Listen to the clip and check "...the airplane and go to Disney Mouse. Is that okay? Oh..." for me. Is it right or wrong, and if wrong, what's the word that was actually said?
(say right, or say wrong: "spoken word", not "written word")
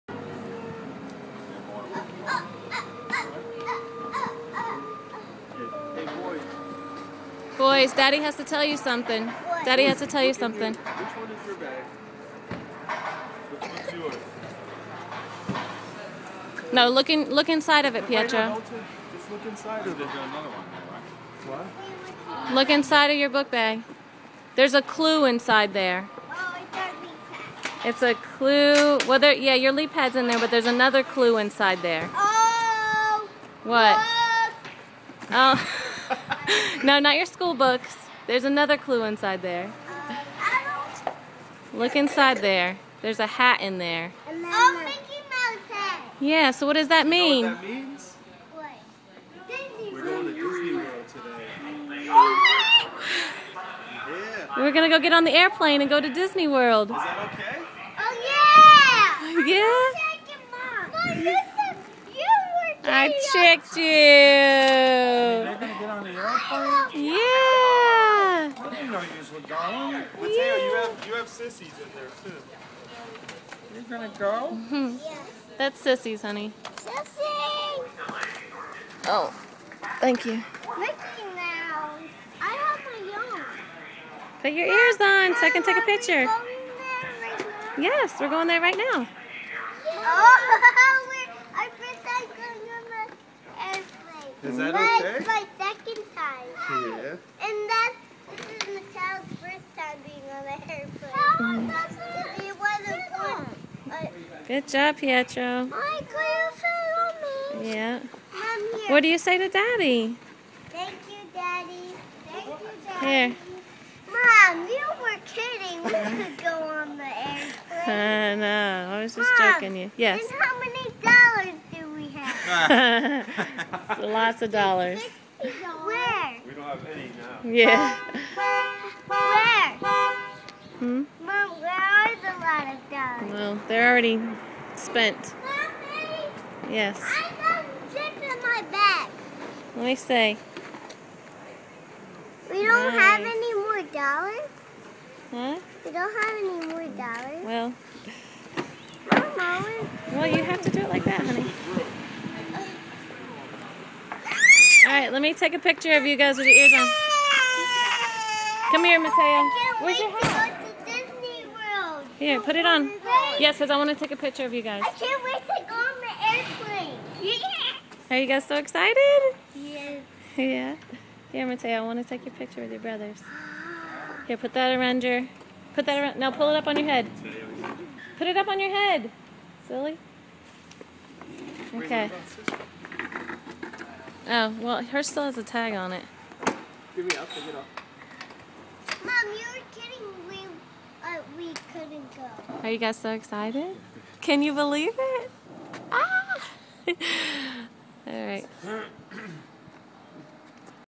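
wrong: "World", not "Mouse".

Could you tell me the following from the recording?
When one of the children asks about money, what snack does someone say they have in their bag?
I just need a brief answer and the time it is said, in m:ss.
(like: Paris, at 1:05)
chips, at 2:17.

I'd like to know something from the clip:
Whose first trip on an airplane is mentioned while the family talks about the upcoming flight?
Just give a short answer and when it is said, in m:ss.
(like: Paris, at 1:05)
Michelle, at 1:38.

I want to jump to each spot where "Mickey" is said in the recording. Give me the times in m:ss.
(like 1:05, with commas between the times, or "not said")
0:44, 1:20.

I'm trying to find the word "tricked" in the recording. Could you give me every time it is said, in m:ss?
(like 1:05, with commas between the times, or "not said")
1:03.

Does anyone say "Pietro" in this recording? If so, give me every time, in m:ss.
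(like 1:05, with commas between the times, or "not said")
0:18, 1:44.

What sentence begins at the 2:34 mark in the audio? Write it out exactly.
Alright, let me take a picture of you guys with your ears on.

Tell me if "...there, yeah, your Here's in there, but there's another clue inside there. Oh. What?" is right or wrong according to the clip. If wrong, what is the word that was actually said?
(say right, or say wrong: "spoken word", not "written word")
wrong: "LeapPad", not "Here".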